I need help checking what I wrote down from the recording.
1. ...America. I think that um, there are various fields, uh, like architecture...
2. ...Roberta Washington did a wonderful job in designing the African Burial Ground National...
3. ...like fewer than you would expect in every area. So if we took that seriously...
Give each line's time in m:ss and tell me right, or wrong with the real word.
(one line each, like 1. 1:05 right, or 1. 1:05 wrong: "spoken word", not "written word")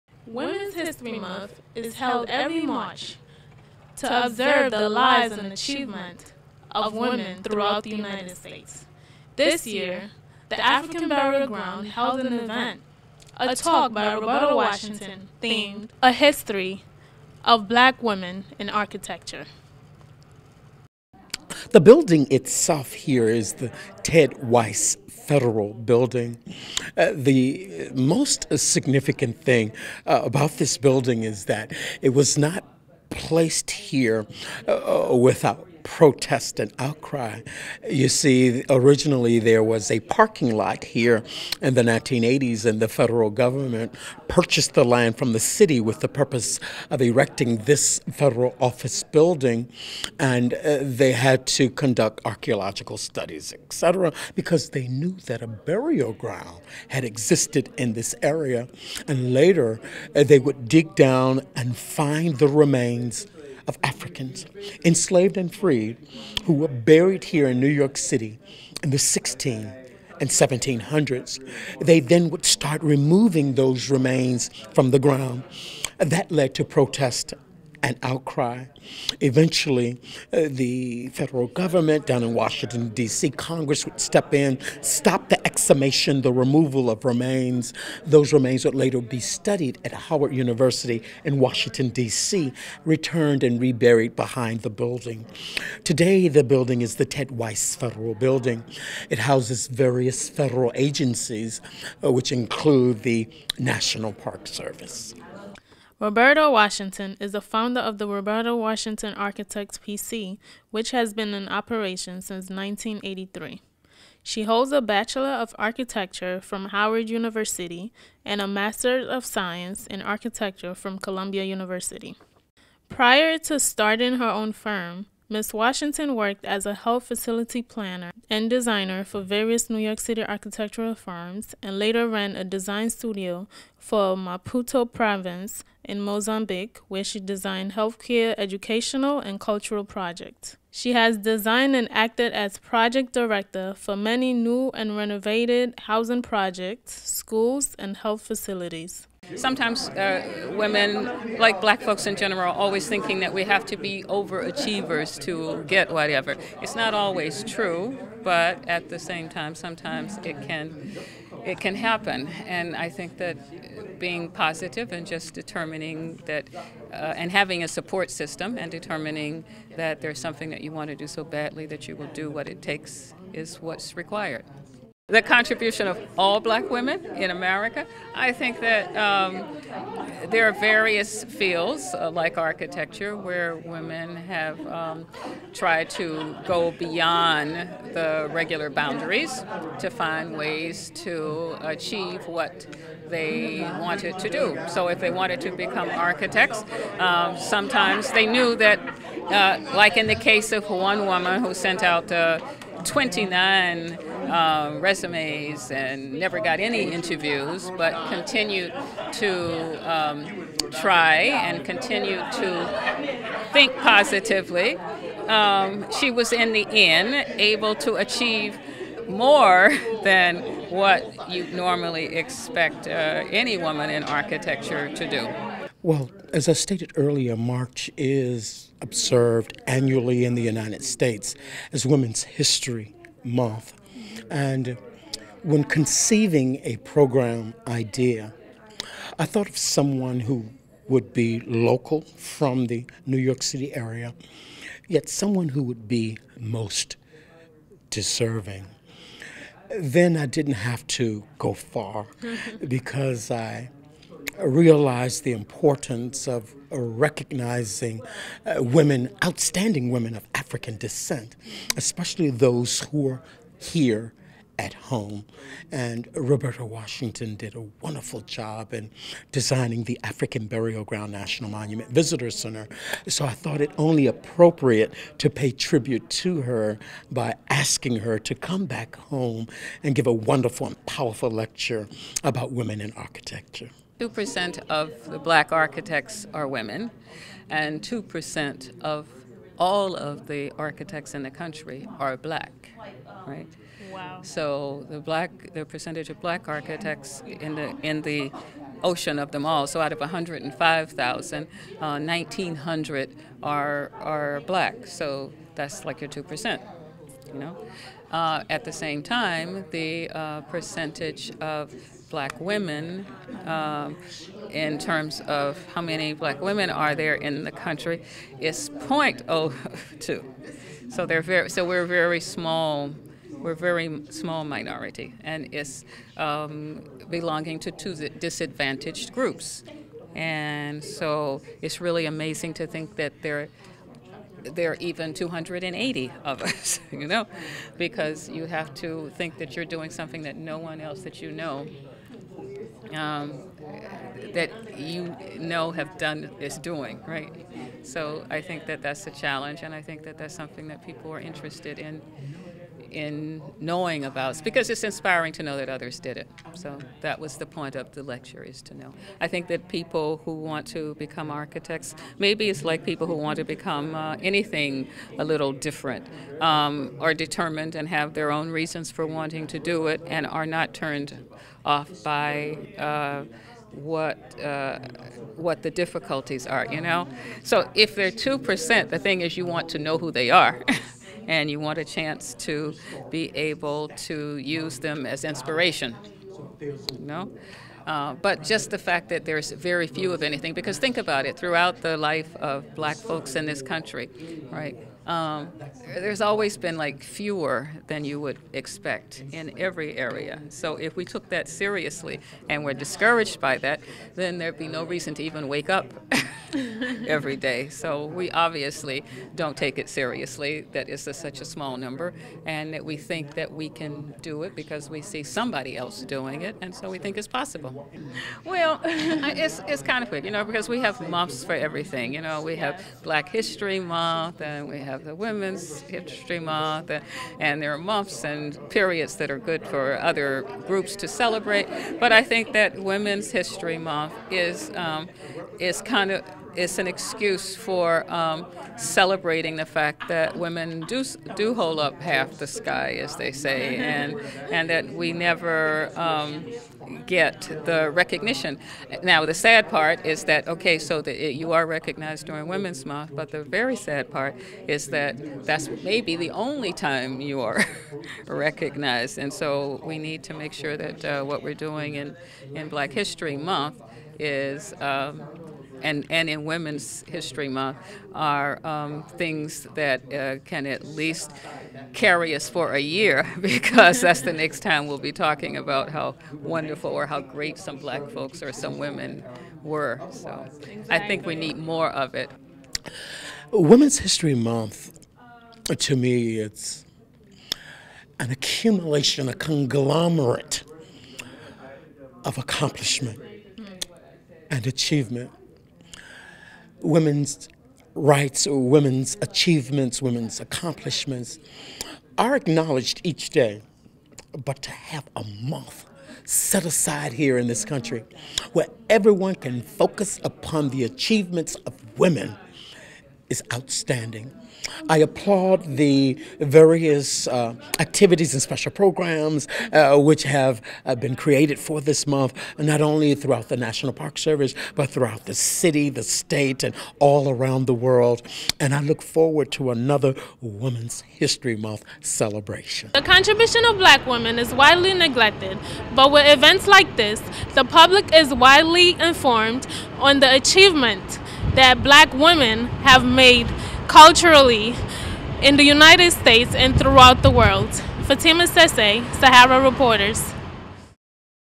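1. 2:57 right
2. 4:26 right
3. 6:36 right.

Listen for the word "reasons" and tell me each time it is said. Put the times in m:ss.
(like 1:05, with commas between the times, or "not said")
6:08, 6:44.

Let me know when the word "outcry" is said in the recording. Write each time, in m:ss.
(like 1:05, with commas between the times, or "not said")
0:36, 1:18.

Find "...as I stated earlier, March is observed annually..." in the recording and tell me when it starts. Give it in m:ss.
3:46.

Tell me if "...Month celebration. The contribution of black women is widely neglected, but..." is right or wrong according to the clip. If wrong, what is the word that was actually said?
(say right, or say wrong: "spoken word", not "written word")
right.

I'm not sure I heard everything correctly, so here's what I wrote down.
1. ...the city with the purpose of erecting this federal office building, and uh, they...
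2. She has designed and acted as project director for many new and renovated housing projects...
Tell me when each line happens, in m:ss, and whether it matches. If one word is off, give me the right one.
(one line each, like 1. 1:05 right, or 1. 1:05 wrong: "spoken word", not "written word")
1. 0:45 right
2. 2:20 right.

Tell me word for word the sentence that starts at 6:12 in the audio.
Uh, what uh, what the difficulties are, you know.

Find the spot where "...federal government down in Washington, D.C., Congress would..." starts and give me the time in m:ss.
1:21.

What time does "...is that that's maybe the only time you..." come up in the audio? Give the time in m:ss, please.
7:34.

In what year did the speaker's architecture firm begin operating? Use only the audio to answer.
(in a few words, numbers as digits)
1983.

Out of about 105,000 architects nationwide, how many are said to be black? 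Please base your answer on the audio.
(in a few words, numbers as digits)
1,900.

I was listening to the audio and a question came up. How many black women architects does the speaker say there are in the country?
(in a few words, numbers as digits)
280.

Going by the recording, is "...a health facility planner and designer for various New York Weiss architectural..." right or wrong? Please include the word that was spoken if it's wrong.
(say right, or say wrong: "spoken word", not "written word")
wrong: "City", not "Weiss".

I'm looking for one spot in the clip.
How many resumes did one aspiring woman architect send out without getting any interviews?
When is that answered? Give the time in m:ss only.
3:22.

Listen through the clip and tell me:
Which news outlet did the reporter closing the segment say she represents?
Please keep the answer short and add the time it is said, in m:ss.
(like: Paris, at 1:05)
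Sahara Reporters, at 9:09.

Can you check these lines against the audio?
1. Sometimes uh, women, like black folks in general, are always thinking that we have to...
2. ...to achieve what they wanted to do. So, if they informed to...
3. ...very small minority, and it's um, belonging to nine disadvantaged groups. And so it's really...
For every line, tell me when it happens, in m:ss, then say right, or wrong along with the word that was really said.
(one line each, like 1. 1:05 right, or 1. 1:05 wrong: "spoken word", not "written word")
1. 2:29 right
2. 3:11 wrong: "wanted", not "informed"
3. 5:23 wrong: "two", not "nine".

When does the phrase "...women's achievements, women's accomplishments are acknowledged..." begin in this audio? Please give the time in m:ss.
8:18.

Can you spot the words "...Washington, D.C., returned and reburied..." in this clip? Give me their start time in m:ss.
1:31.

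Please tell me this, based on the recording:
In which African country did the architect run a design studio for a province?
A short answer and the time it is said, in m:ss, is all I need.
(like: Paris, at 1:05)
Mozambique, at 2:16.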